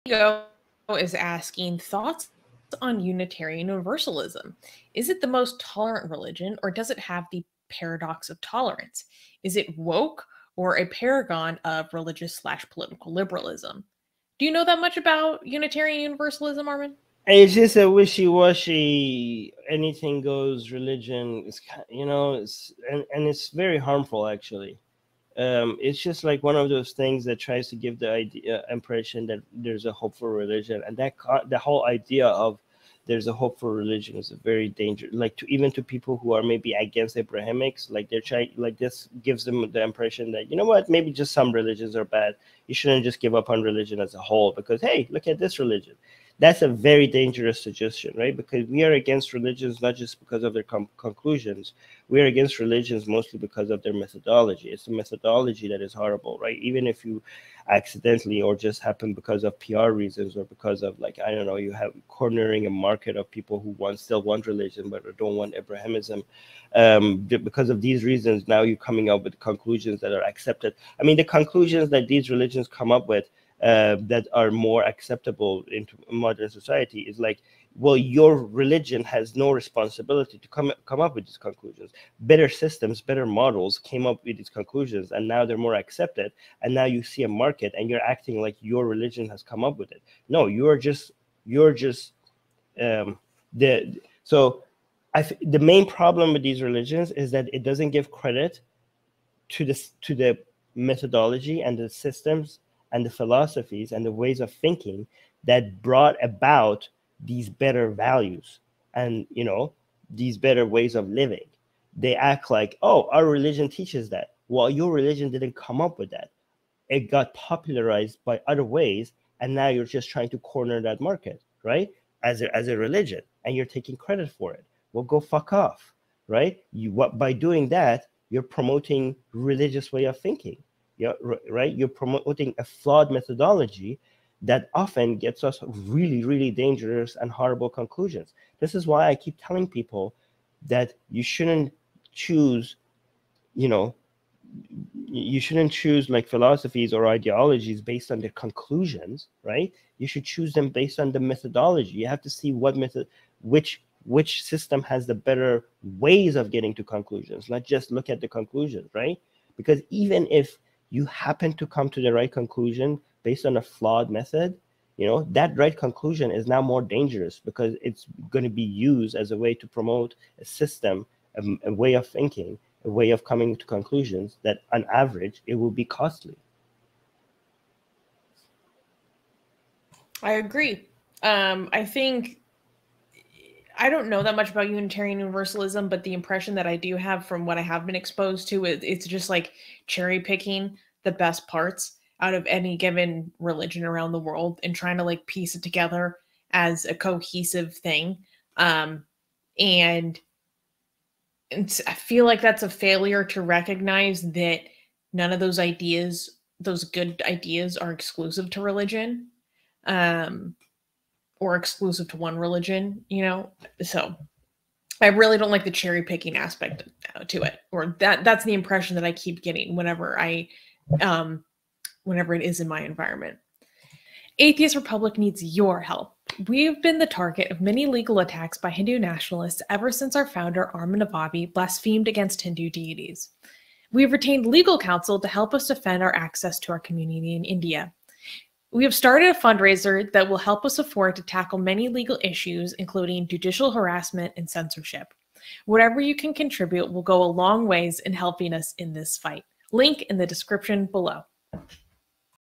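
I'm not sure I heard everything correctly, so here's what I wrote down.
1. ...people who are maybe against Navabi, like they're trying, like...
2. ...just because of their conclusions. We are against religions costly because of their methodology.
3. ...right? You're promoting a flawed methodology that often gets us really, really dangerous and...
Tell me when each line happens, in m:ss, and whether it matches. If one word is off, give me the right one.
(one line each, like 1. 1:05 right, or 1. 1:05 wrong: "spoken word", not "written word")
1. 0:35 wrong: "Abrahamics", not "Navabi"
2. 0:49 wrong: "mostly", not "costly"
3. 2:11 right.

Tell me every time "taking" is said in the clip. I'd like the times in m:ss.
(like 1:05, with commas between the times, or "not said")
2:03.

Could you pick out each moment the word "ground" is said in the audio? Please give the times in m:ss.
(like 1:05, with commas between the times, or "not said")
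not said.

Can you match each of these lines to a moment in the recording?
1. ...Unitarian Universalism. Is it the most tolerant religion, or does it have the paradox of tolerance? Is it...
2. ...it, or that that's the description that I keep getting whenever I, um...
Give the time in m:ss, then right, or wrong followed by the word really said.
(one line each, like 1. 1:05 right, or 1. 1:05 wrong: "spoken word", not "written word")
1. 0:02 right
2. 3:37 wrong: "impression", not "description".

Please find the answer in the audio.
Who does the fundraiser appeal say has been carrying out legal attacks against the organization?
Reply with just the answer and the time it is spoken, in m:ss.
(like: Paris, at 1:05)
Hindu nationalists, at 3:48.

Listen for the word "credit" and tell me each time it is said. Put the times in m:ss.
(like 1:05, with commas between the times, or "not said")
1:38, 2:03.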